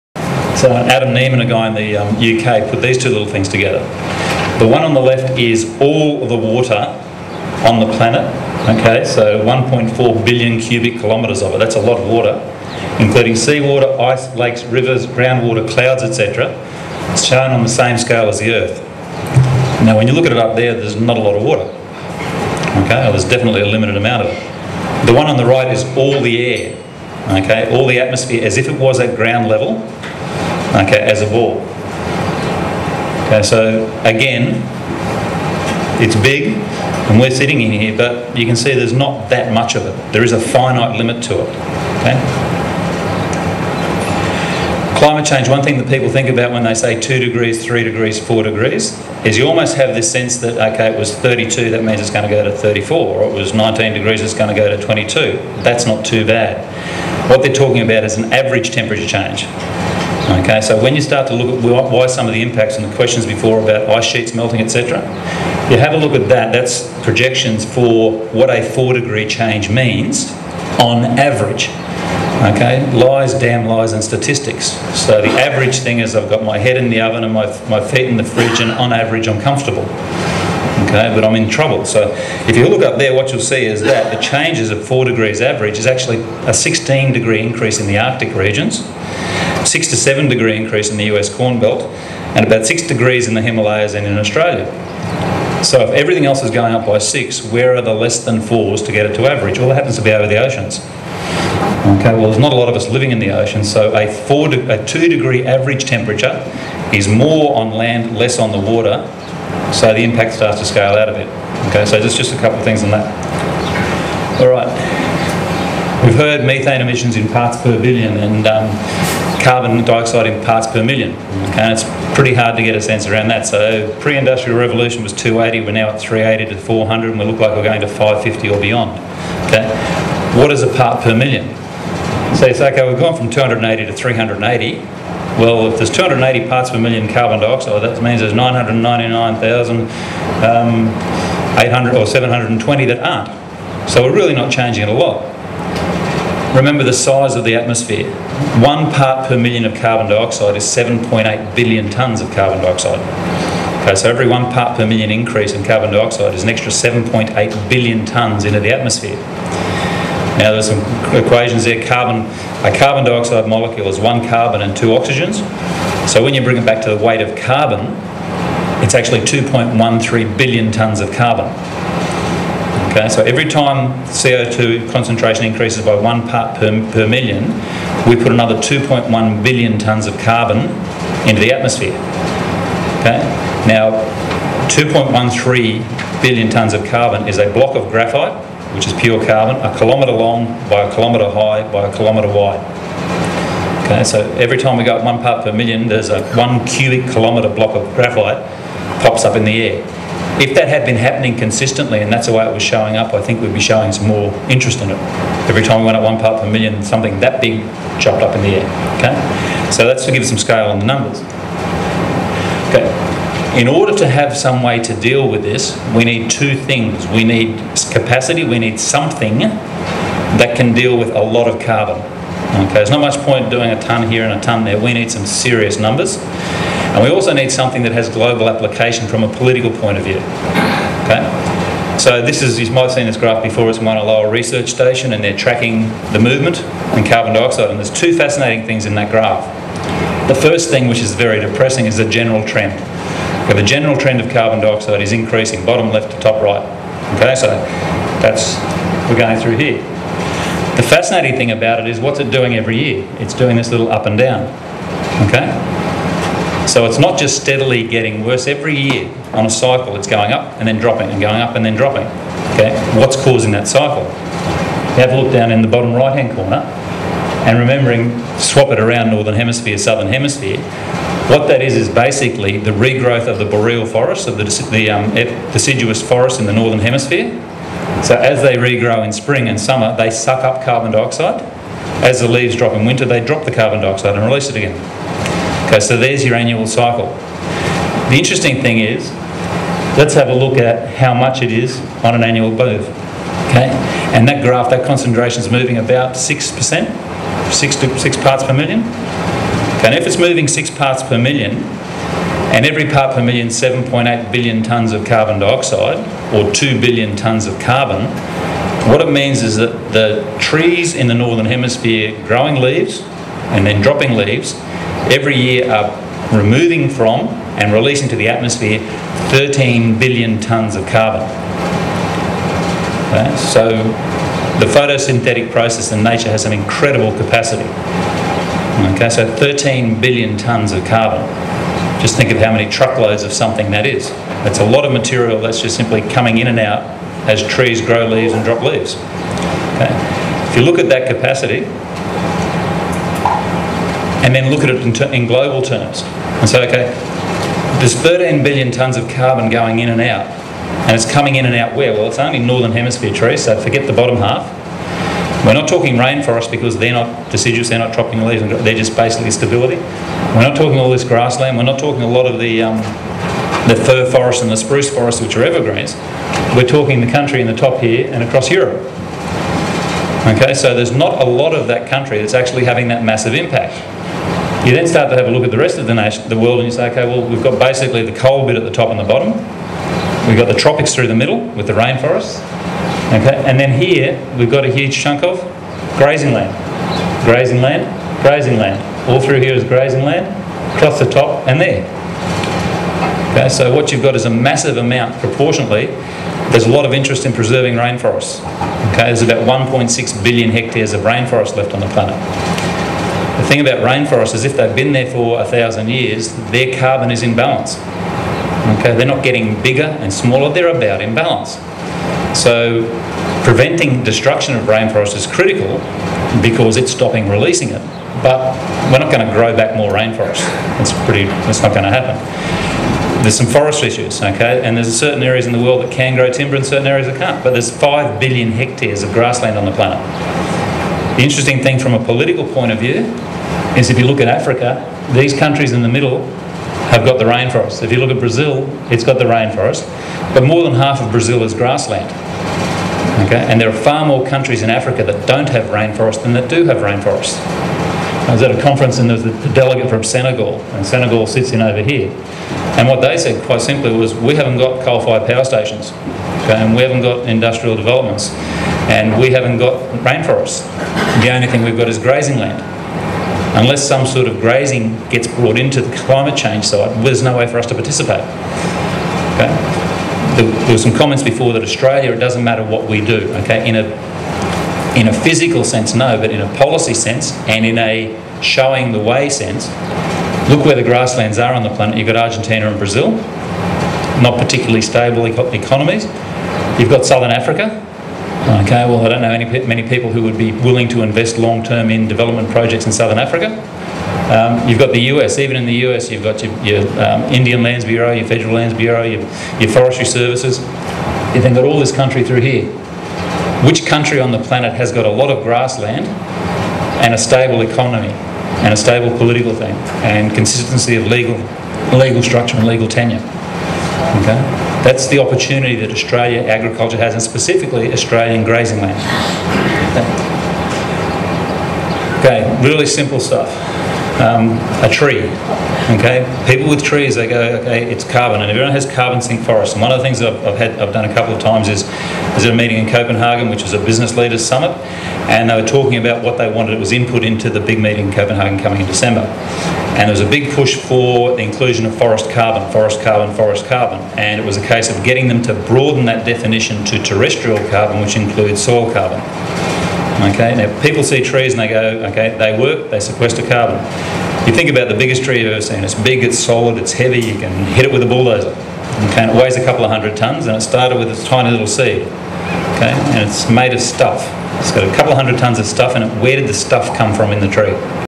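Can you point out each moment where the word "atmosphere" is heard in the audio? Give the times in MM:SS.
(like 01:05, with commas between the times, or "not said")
00:27, 02:27, 02:38, 03:01, 05:18.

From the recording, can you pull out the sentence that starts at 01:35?
So if everything else is going up by 6, where are the less than 4s to get it to average?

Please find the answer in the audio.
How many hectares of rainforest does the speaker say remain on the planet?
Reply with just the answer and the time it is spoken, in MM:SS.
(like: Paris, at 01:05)
1.6 billion hectares, at 06:39.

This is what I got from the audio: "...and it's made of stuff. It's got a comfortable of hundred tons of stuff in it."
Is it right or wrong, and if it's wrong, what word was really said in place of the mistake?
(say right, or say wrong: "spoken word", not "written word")
wrong: "couple", not "comfortable".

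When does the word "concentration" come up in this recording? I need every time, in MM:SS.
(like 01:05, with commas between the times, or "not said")
02:54, 04:54.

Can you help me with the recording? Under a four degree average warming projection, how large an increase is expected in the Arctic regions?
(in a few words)
16 degrees.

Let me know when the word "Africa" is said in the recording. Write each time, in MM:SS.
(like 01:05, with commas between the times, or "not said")
07:14, 07:24, 08:07, 08:13.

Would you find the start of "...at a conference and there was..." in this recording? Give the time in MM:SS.
07:28.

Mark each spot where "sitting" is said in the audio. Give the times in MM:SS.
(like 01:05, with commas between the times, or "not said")
00:37.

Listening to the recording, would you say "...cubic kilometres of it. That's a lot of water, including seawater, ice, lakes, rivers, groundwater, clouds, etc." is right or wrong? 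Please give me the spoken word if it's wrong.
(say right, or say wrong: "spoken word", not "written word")
right.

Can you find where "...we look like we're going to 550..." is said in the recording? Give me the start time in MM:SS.
02:07.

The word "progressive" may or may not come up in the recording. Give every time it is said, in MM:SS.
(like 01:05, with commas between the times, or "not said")
not said.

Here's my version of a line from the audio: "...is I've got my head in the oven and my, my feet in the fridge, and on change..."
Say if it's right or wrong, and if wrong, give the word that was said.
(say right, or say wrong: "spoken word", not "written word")
wrong: "average", not "change".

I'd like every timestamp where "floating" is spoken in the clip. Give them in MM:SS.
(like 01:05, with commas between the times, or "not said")
not said.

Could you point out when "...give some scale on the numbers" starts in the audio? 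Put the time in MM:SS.
03:30.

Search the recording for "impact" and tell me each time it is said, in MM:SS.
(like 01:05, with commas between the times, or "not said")
01:02, 01:50, 06:13.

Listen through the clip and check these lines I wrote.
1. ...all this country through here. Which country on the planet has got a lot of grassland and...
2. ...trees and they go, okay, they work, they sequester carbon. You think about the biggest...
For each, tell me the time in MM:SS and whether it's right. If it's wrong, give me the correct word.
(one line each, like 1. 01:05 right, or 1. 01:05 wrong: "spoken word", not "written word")
1. 08:21 right
2. 09:11 right.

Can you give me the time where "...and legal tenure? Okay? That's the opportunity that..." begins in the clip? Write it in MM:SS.
08:32.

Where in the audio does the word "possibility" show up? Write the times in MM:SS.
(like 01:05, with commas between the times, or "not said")
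not said.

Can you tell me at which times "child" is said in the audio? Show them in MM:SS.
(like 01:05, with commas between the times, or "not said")
not said.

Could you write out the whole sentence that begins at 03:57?
And there's two fascinating things in that graph.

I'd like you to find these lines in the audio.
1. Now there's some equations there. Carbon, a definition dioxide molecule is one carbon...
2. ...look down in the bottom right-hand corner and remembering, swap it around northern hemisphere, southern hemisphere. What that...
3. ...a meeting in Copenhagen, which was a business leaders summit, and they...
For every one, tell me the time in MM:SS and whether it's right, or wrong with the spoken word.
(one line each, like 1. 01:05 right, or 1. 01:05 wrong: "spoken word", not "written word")
1. 02:40 wrong: "carbon", not "definition"
2. 04:25 right
3. 08:52 right.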